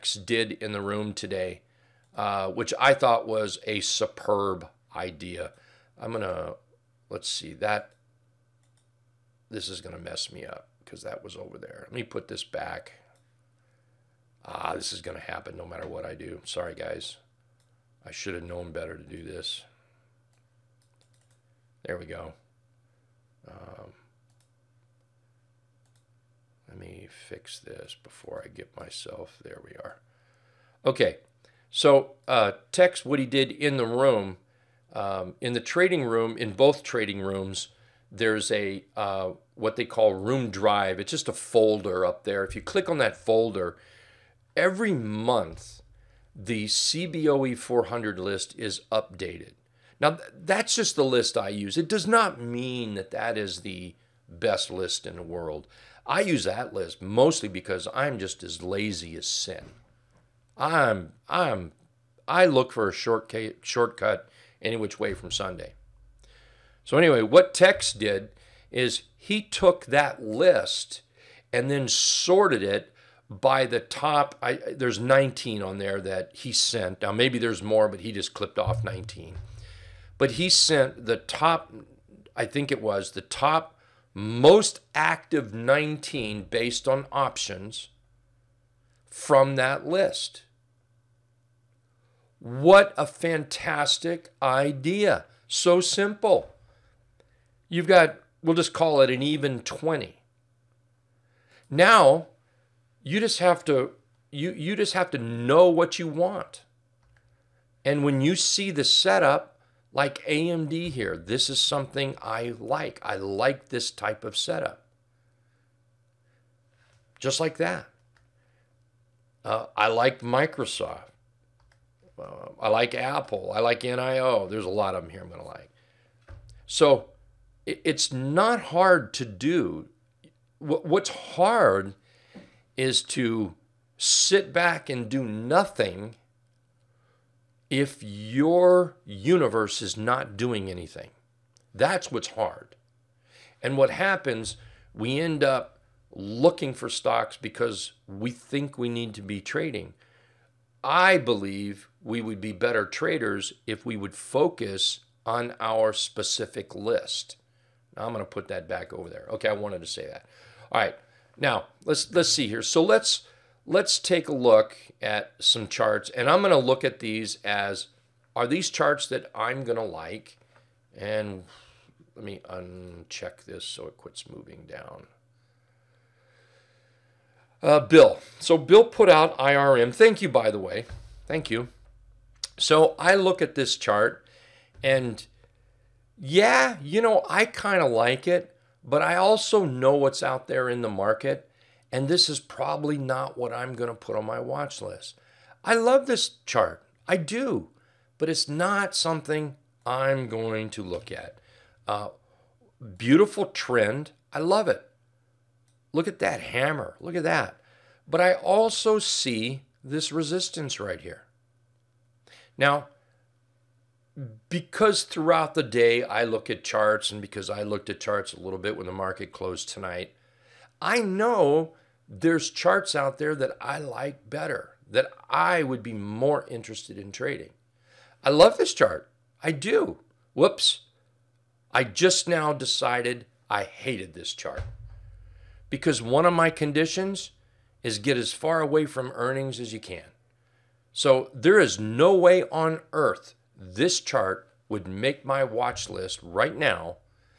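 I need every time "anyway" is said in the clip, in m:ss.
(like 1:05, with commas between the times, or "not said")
1:06.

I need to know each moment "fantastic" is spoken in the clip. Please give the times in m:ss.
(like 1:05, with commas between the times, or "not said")
1:33.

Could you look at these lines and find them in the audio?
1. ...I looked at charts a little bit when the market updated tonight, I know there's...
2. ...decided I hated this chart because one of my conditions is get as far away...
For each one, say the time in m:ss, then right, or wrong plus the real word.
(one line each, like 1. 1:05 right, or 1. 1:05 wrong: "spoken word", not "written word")
1. 3:37 wrong: "closed", not "updated"
2. 3:52 right.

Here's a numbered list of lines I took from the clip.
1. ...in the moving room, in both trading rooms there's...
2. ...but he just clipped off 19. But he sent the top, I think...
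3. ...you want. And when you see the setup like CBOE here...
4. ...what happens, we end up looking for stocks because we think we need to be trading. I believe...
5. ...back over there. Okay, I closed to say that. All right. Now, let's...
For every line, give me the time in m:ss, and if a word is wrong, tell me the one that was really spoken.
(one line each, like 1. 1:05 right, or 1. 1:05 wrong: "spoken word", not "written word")
1. 0:35 wrong: "trading", not "moving"
2. 1:17 right
3. 1:45 wrong: "AMD", not "CBOE"
4. 2:23 right
5. 2:38 wrong: "wanted", not "closed".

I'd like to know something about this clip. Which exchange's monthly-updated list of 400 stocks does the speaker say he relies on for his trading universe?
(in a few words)
CBOE.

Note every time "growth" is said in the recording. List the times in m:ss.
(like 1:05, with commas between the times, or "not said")
not said.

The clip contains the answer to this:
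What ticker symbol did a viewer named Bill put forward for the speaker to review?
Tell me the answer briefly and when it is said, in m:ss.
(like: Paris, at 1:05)
IRM, at 2:59.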